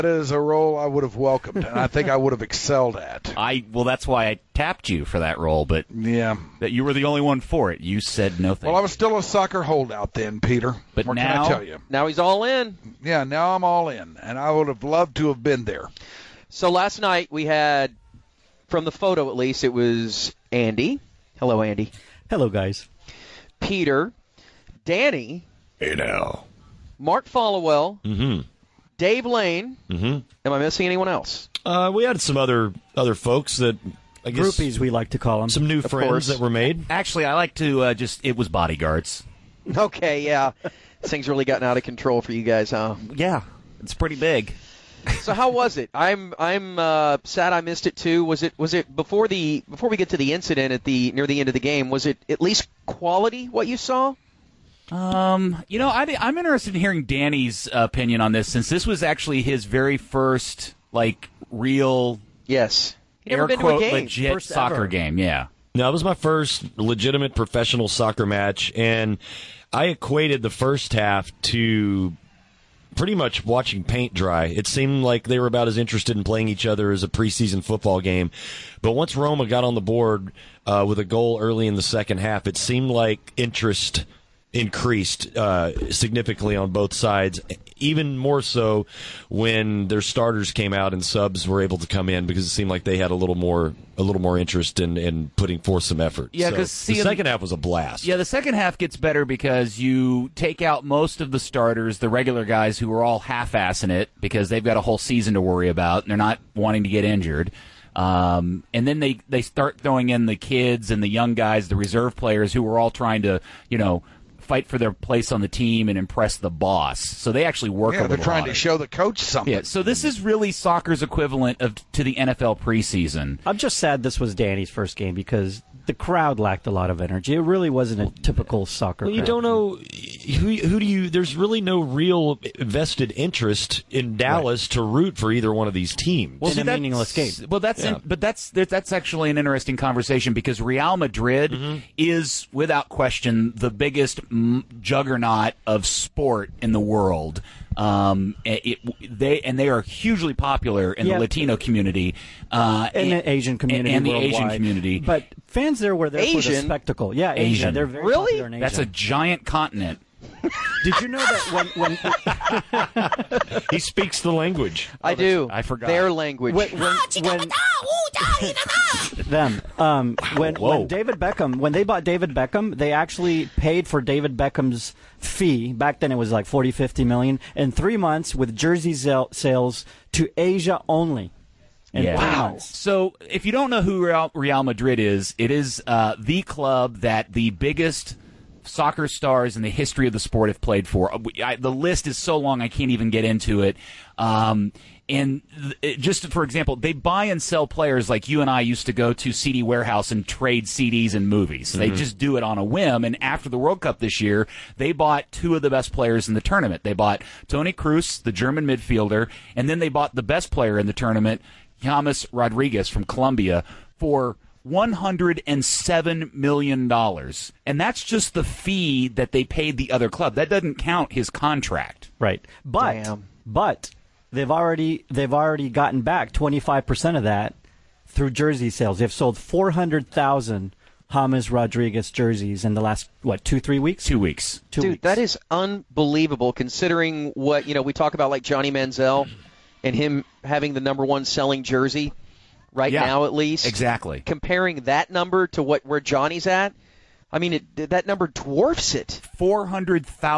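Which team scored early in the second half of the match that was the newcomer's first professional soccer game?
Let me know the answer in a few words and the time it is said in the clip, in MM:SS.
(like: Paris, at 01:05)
Roma, at 01:19.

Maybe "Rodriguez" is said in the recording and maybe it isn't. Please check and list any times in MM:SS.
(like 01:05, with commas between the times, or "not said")
03:32, 03:51.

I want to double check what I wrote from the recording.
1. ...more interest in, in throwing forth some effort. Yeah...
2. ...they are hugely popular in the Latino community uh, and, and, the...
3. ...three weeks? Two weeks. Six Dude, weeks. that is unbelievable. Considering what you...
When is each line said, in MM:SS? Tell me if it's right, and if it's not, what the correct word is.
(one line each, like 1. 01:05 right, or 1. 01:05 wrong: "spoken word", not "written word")
1. 01:34 wrong: "putting", not "throwing"
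2. 02:29 right
3. 03:53 wrong: "Two", not "Six".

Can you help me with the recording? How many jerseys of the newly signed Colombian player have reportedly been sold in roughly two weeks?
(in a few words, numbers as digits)
400,000.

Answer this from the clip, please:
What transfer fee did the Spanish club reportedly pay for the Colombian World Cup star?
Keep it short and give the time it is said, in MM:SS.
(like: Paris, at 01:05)
$107 million, at 03:34.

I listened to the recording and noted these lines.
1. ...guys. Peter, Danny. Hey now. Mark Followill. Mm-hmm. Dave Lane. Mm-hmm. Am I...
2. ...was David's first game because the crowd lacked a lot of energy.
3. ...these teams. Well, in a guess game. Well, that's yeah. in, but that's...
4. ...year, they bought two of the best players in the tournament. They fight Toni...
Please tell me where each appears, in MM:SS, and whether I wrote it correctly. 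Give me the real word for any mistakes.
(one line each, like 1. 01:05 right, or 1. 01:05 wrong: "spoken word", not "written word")
1. 00:22 right
2. 02:04 wrong: "Danny", not "David"
3. 02:15 wrong: "meaningless", not "guess"
4. 03:24 wrong: "bought", not "fight".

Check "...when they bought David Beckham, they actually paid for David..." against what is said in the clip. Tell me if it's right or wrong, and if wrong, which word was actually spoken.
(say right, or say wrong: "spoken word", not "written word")
right.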